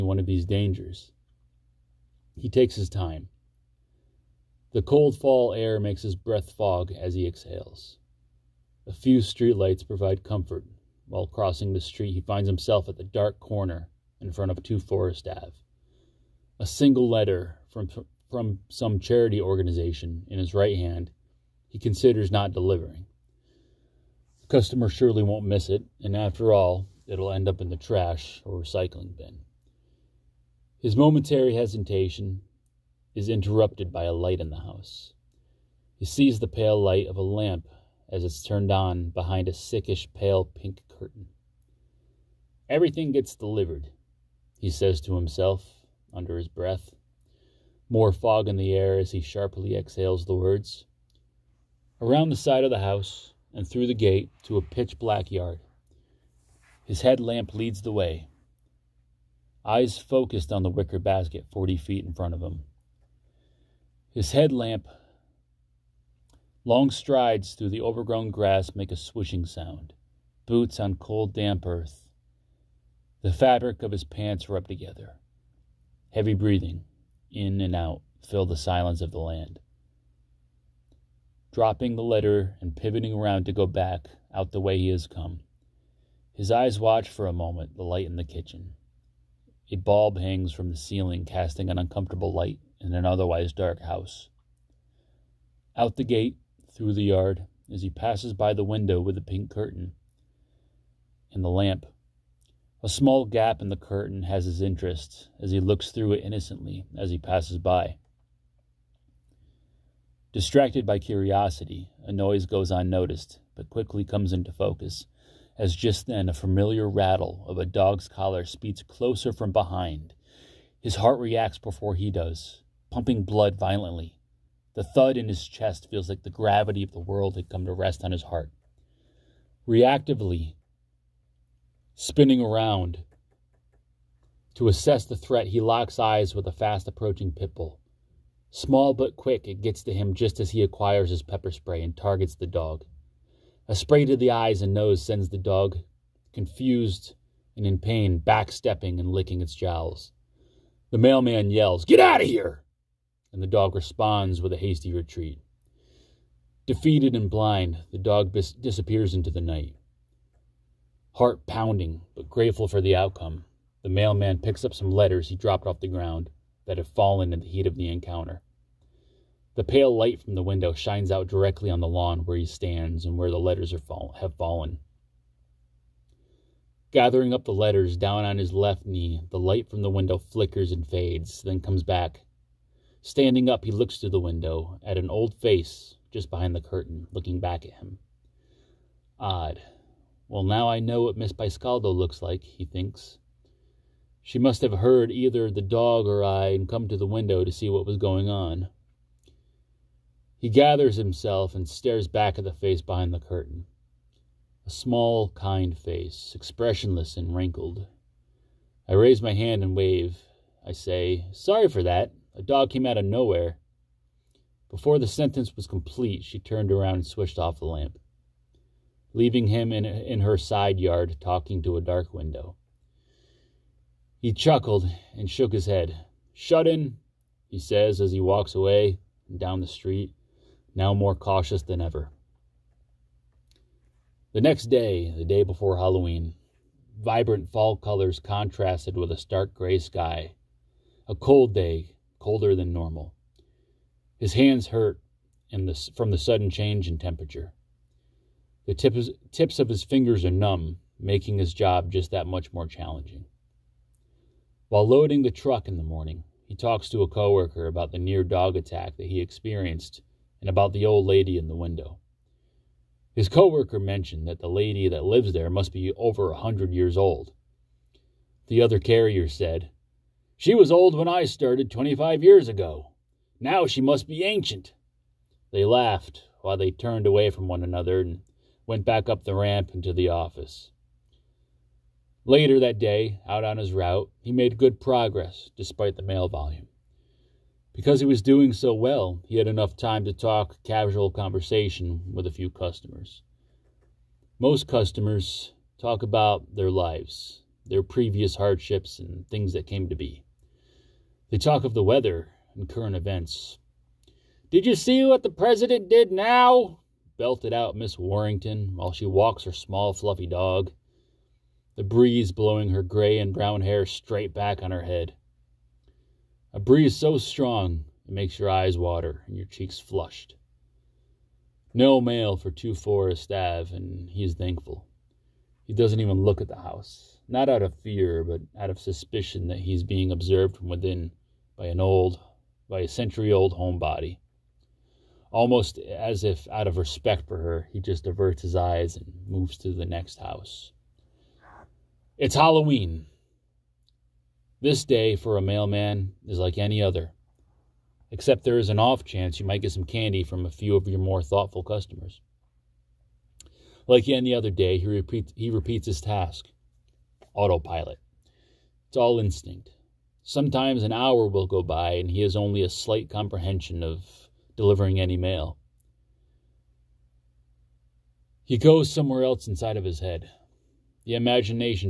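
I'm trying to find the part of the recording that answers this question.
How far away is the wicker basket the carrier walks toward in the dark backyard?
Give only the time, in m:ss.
1:01.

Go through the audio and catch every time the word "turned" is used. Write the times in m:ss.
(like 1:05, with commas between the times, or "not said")
0:38, 3:36, 4:36.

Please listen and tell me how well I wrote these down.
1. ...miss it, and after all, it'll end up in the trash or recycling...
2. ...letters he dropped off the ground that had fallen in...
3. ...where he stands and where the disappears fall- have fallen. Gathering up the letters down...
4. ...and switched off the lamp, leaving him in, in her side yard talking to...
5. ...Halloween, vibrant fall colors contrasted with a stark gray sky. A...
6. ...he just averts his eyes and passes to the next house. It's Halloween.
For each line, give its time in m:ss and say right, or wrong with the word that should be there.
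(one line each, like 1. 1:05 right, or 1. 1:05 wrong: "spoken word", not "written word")
1. 0:25 right
2. 2:44 right
3. 2:52 wrong: "letters", not "disappears"
4. 3:36 right
5. 3:55 right
6. 5:37 wrong: "moves", not "passes".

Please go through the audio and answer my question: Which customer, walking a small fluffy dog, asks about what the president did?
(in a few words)
Miss Warrington.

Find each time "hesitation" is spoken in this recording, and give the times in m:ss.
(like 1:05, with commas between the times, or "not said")
0:31.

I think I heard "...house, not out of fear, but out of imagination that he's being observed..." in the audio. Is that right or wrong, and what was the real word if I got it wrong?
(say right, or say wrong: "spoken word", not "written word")
wrong: "suspicion", not "imagination".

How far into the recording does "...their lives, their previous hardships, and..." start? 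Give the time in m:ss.
4:56.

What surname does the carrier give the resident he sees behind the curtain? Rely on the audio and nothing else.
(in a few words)
Piscaldo.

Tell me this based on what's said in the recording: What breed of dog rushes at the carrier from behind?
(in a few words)
Pit bull.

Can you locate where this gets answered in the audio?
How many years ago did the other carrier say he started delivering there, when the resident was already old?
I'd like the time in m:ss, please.
4:31.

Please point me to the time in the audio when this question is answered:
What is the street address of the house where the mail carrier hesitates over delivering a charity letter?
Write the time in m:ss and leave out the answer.
0:14.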